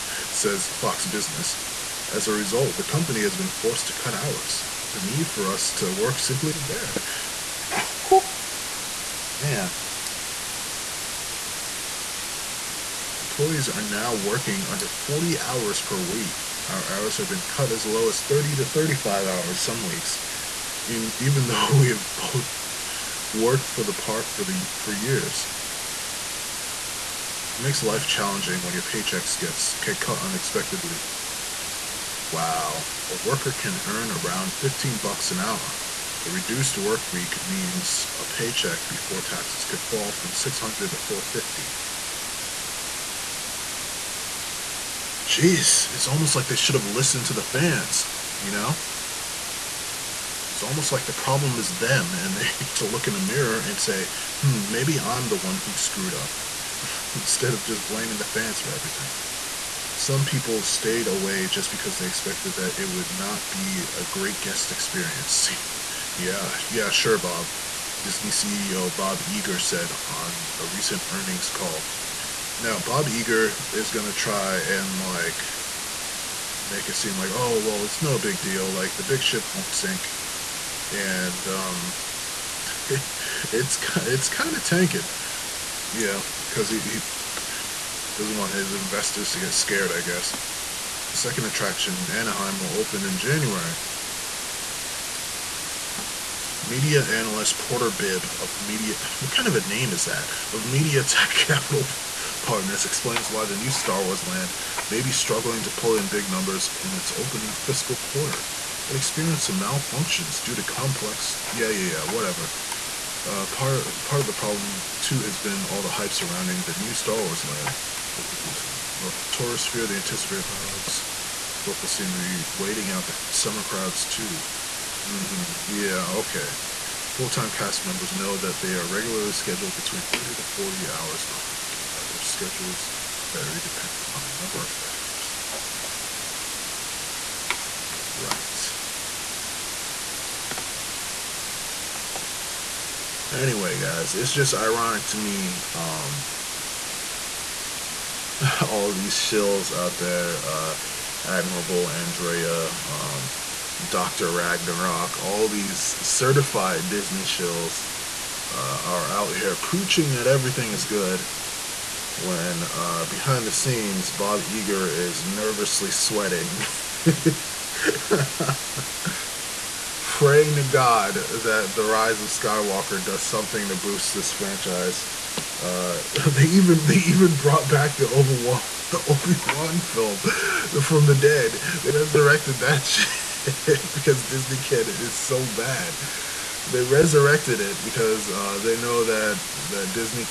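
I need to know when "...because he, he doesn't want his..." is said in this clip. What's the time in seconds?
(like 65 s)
86 s.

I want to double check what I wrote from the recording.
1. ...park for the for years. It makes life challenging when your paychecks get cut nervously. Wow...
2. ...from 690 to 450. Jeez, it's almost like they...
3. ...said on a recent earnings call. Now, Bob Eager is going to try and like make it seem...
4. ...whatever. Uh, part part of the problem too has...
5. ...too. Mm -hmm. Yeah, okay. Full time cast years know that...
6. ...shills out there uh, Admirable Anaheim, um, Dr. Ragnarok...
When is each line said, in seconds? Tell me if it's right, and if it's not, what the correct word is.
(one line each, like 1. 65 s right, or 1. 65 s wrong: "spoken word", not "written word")
1. 23 s wrong: "unexpectedly", not "nervously"
2. 40 s wrong: "600", not "690"
3. 69 s right
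4. 112 s right
5. 124 s wrong: "members", not "years"
6. 149 s wrong: "Andrea", not "Anaheim".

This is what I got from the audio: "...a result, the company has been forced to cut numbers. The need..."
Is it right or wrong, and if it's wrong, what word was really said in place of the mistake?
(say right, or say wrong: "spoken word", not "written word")
wrong: "hours", not "numbers".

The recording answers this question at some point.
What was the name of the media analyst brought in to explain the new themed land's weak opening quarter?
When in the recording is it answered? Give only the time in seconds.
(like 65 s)
97 s.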